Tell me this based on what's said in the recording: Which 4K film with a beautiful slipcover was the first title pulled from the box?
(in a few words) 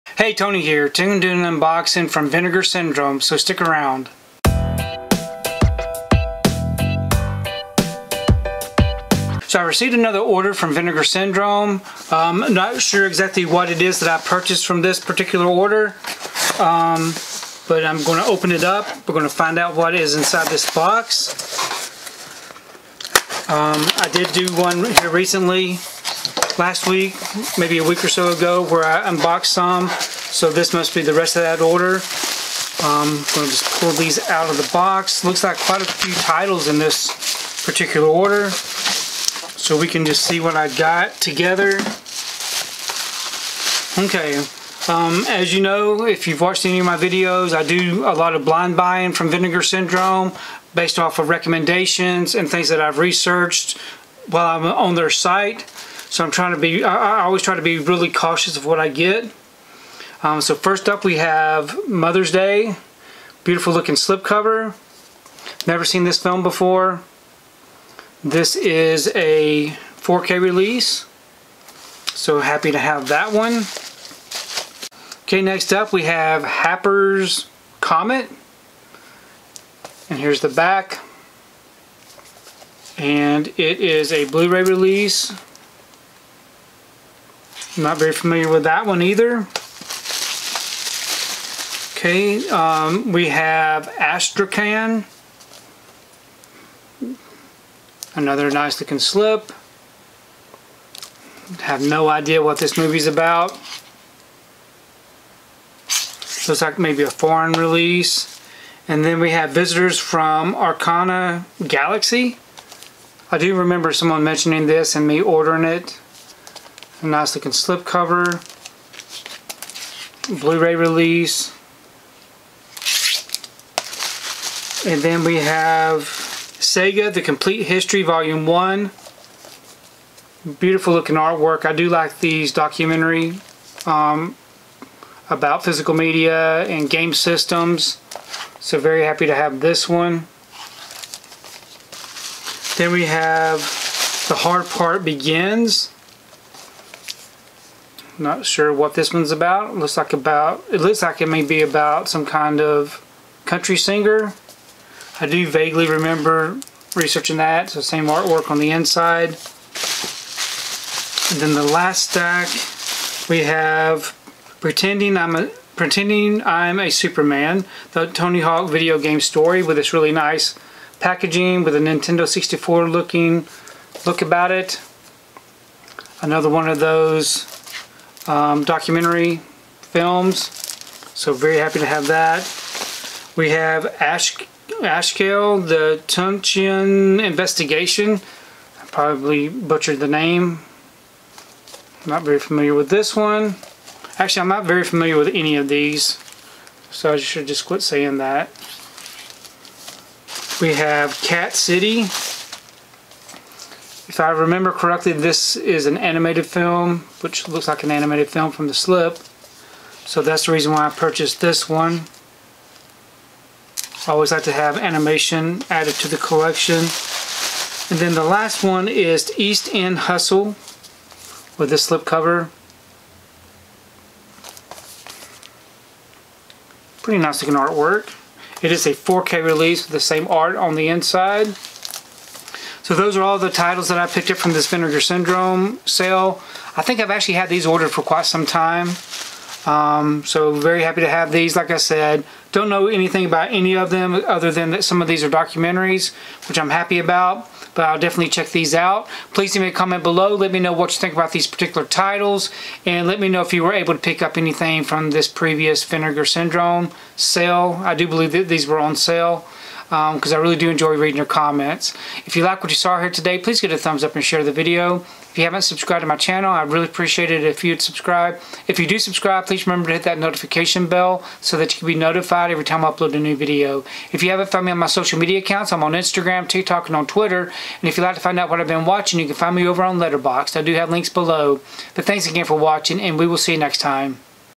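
Mother's Day.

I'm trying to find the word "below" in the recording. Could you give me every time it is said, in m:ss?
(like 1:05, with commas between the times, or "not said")
4:10, 4:41.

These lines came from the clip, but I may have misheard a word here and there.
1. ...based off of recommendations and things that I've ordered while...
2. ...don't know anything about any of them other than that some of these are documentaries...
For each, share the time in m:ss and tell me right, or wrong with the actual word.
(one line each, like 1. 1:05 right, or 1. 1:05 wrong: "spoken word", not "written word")
1. 0:50 wrong: "researched", not "ordered"
2. 4:02 right.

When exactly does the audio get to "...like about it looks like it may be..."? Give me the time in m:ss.
2:29.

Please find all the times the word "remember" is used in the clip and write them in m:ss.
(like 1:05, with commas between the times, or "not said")
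1:53, 2:35, 3:24, 4:29.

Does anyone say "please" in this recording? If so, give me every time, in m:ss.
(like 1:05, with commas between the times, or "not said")
4:09, 4:23, 4:29.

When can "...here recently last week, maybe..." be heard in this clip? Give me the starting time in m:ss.
0:24.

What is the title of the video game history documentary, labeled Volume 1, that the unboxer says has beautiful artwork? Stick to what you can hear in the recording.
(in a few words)
Sega, The Complete History.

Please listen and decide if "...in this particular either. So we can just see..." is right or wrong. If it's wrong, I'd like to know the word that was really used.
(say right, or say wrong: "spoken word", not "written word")
wrong: "order", not "either".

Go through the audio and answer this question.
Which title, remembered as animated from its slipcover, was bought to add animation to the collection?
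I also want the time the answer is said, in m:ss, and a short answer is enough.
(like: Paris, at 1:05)
Cat City, at 3:21.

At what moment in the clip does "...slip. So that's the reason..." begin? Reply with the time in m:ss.
3:28.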